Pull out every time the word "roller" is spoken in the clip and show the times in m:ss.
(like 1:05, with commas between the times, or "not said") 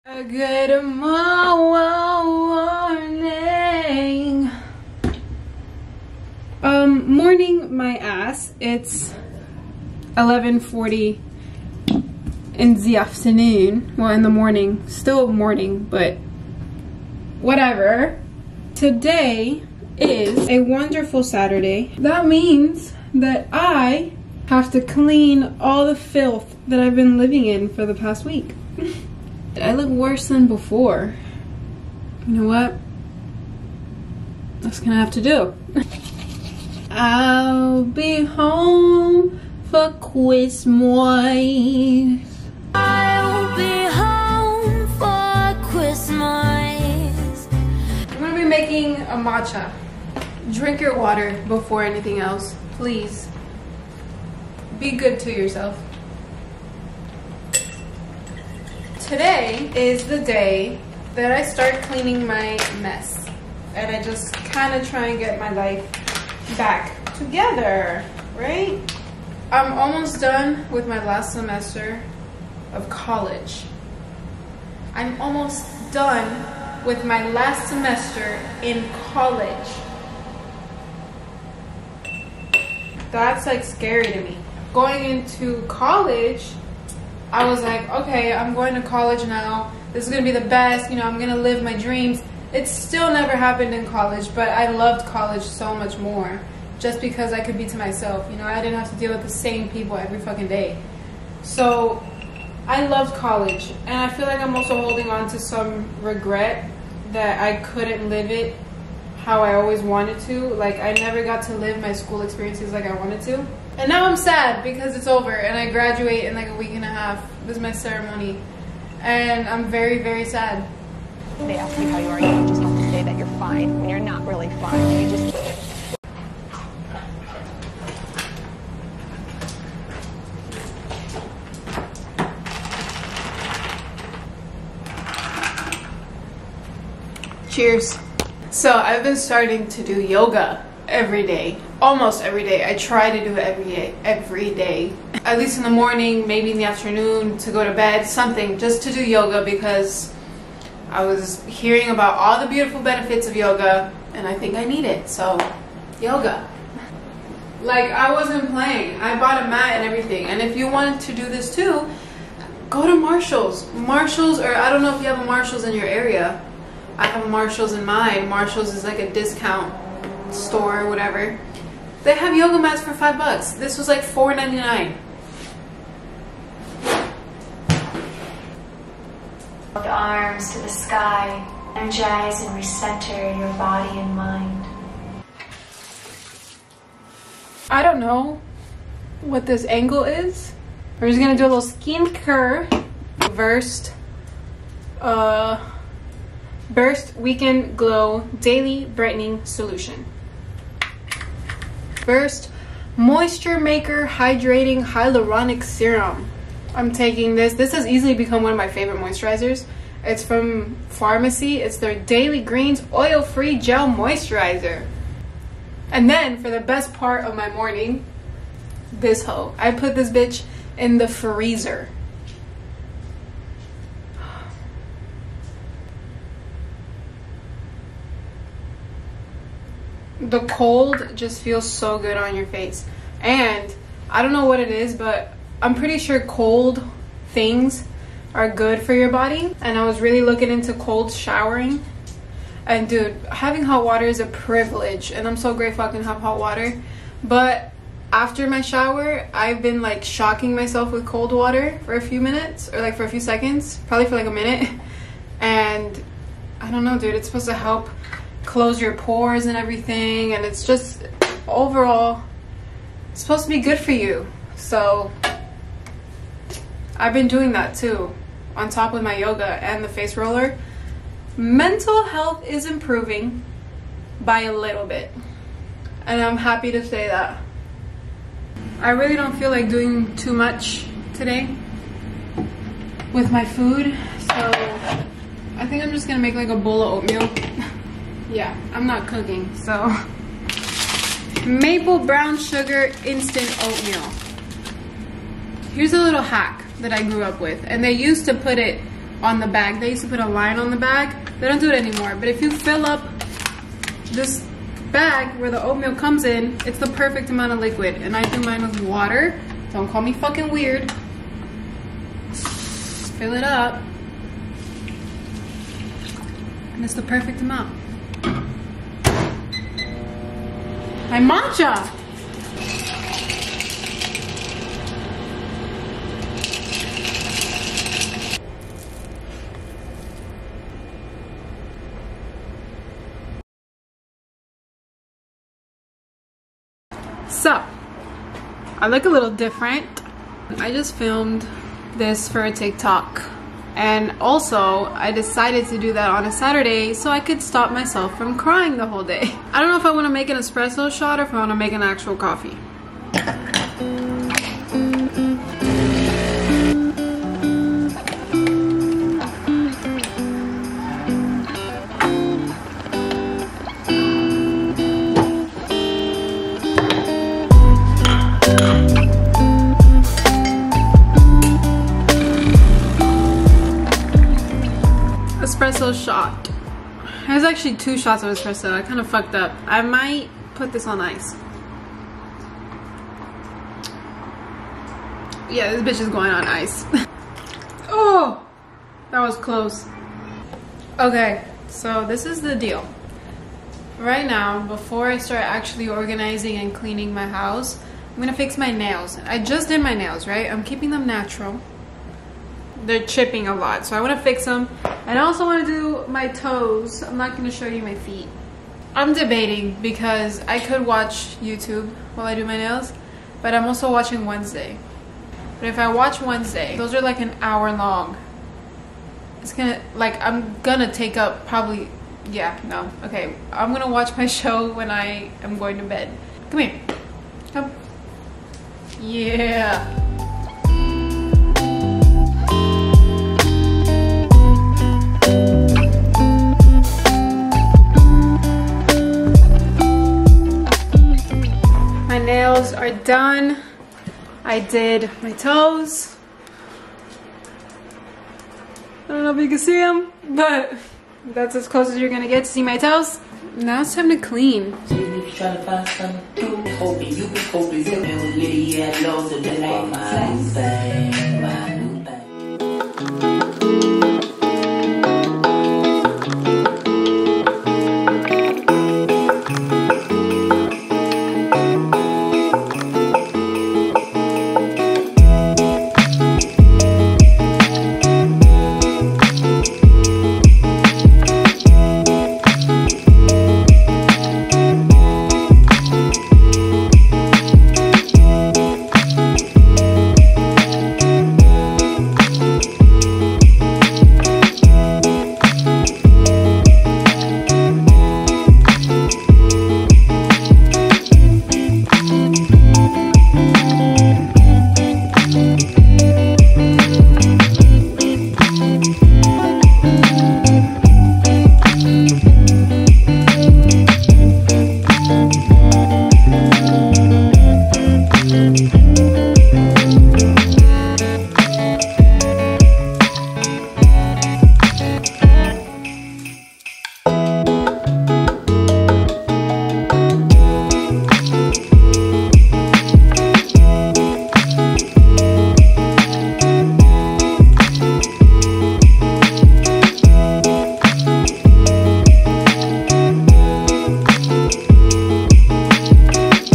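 4:30.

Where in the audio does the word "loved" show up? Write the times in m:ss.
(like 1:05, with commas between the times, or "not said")
1:34, 1:42.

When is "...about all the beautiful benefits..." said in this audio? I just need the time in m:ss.
2:31.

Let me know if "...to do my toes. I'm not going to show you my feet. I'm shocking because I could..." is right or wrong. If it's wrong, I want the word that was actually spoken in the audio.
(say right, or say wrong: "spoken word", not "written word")
wrong: "debating", not "shocking".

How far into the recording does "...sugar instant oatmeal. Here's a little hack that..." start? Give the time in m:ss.
4:52.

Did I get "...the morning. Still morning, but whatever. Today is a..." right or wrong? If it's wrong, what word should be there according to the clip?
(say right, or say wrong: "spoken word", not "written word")
right.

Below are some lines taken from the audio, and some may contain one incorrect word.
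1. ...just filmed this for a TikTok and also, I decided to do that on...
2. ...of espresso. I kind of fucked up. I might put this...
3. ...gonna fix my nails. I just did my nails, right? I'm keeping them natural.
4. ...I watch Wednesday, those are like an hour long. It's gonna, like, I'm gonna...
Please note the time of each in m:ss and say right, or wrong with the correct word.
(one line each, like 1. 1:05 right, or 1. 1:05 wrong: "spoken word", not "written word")
1. 5:40 right
2. 6:18 right
3. 6:38 right
4. 6:55 right.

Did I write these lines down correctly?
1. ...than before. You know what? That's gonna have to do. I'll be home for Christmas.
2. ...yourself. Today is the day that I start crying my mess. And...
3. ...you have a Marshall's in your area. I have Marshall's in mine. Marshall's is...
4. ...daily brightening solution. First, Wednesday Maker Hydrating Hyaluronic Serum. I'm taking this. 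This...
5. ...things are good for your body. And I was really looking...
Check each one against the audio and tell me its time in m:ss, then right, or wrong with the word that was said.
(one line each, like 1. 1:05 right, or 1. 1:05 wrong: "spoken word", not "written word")
1. 0:30 right
2. 0:55 wrong: "cleaning", not "crying"
3. 2:45 right
4. 3:18 wrong: "Moisture", not "Wednesday"
5. 3:57 right.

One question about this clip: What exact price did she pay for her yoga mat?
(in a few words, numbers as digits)
$4.99.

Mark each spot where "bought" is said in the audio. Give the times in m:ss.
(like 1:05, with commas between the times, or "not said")
2:39.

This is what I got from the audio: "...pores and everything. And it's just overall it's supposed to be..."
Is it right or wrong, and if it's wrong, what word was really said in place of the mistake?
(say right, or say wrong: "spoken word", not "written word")
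right.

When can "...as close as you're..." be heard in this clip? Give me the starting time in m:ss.
7:31.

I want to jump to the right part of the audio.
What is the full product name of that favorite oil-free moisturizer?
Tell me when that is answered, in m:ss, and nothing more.
3:31.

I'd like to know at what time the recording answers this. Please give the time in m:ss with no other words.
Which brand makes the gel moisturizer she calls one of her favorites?
3:30.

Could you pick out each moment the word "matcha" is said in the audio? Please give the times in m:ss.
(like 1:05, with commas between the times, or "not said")
0:49, 5:21.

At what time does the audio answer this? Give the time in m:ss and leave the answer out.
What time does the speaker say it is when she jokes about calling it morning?
0:10.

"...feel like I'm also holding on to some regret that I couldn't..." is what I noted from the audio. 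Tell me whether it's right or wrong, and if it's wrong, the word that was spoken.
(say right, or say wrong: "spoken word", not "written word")
right.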